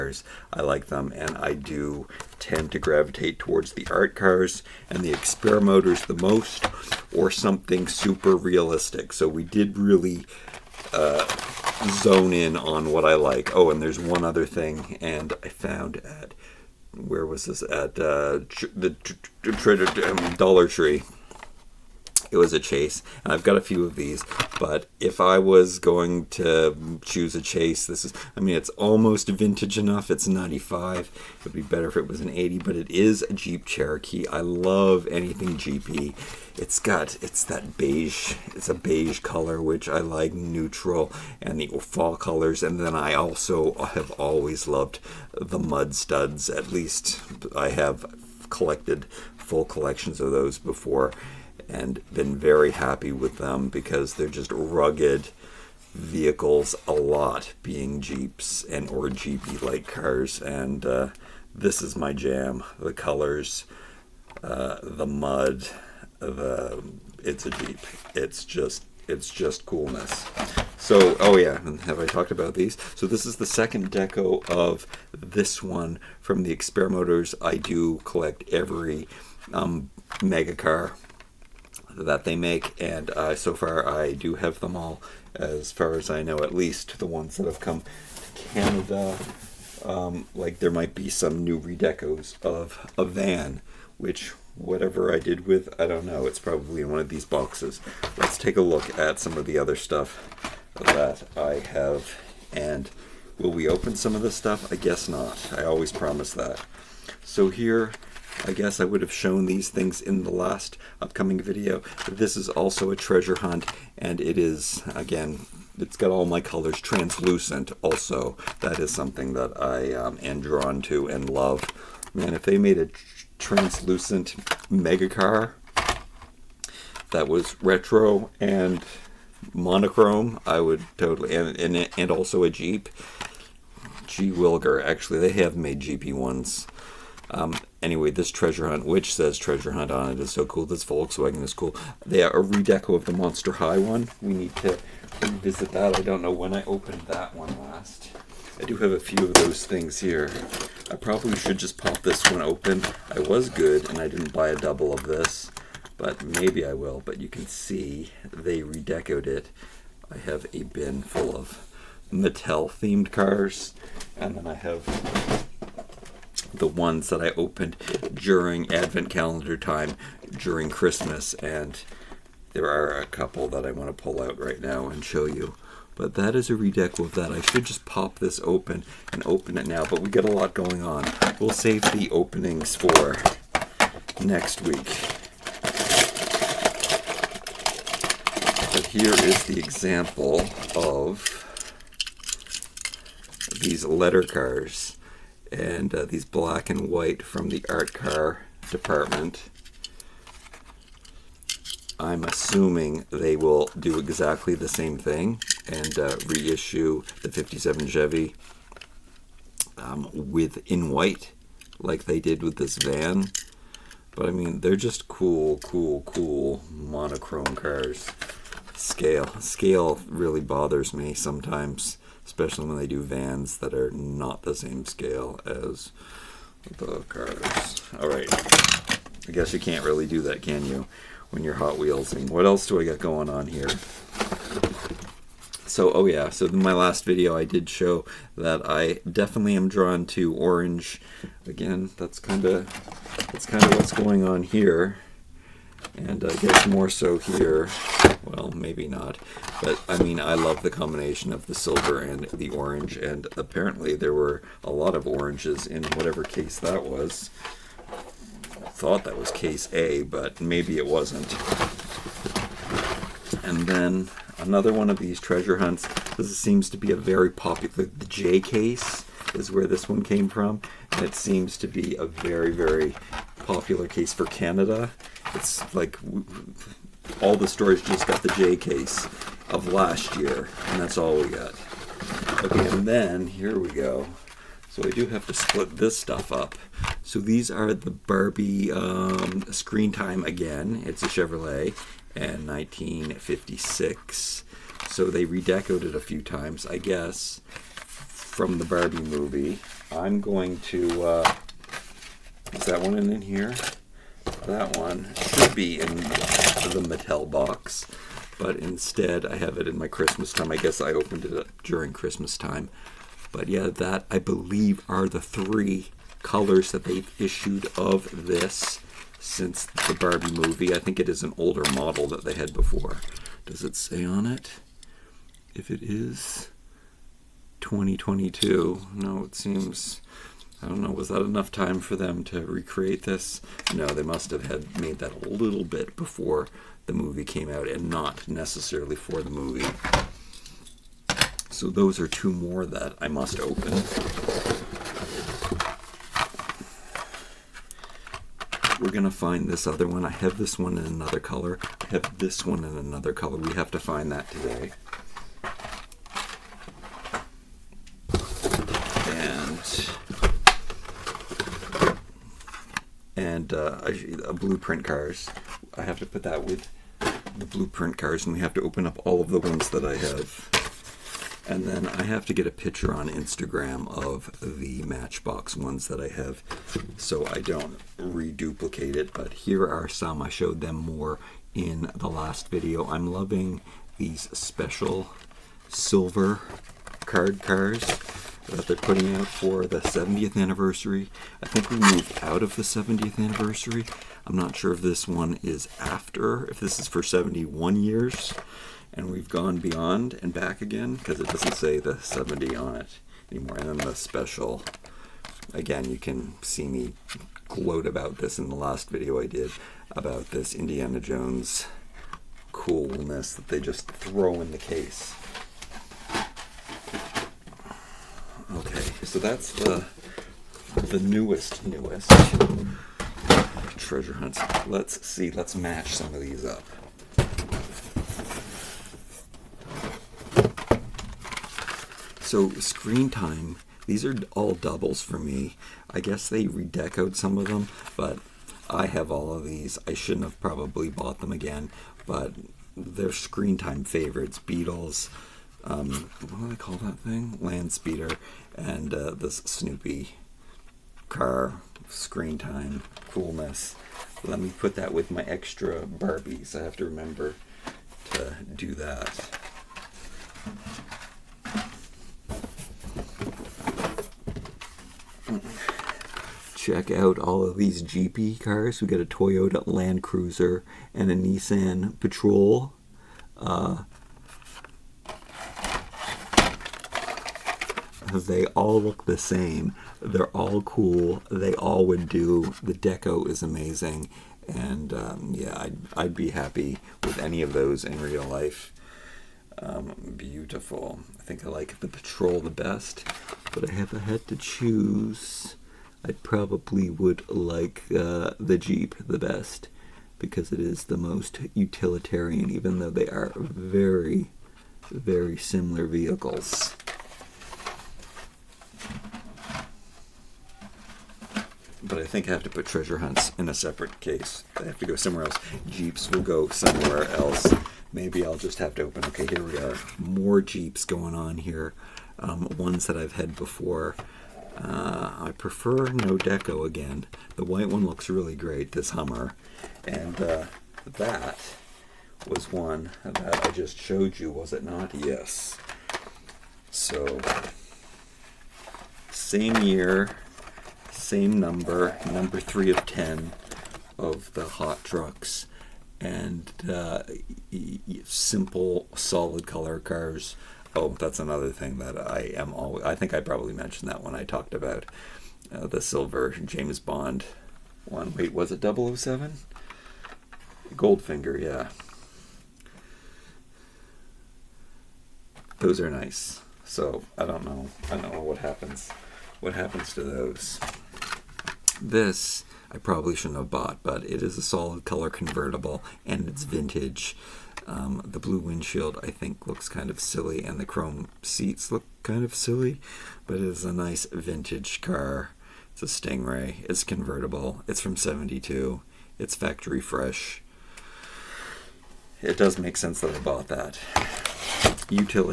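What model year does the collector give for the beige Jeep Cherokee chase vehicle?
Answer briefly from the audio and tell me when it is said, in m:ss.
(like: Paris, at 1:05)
95, at 0:30.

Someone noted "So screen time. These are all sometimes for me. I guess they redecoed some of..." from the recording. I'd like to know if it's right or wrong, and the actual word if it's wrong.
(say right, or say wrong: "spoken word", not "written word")
wrong: "doubles", not "sometimes".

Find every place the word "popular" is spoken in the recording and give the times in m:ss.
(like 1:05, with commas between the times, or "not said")
4:27, 4:33.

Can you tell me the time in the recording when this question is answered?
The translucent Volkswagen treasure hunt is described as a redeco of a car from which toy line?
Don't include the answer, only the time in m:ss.
2:23.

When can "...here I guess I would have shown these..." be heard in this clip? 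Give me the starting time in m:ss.
1:47.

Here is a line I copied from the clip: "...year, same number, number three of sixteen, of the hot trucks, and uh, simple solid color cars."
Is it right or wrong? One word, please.
wrong.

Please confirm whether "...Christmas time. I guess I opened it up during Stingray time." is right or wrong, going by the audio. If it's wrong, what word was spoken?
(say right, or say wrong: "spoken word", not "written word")
wrong: "Christmas", not "Stingray".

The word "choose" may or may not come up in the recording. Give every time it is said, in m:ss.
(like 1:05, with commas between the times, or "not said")
0:27, 8:14.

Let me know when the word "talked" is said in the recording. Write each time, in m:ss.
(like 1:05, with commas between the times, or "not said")
1:12, 9:14.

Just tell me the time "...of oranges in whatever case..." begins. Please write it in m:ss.
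4:14.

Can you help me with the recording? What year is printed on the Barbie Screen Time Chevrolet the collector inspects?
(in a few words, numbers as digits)
2022.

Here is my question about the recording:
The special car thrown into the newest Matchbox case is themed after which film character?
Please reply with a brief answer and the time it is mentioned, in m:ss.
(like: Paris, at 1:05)
Indiana Jones, at 6:50.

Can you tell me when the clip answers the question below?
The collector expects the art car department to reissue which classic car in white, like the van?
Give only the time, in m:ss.
3:27.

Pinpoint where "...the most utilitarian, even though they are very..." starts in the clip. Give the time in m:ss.
8:20.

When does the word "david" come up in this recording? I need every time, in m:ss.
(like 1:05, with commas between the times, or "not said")
not said.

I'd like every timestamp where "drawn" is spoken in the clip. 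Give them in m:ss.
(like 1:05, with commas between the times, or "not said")
2:00, 3:59.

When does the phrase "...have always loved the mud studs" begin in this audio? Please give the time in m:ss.
0:43.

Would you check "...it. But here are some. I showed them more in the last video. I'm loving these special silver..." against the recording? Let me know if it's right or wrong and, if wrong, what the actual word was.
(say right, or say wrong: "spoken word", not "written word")
right.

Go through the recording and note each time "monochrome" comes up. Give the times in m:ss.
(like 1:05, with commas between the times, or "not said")
2:09, 3:36.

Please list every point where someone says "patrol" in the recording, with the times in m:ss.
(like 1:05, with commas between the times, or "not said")
7:51, 8:11.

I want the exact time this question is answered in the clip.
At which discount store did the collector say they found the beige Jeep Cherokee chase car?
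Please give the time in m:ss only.
0:18.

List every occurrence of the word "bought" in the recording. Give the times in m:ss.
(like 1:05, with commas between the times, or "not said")
7:20, 9:33, 9:53.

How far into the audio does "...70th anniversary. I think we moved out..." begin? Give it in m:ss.
6:29.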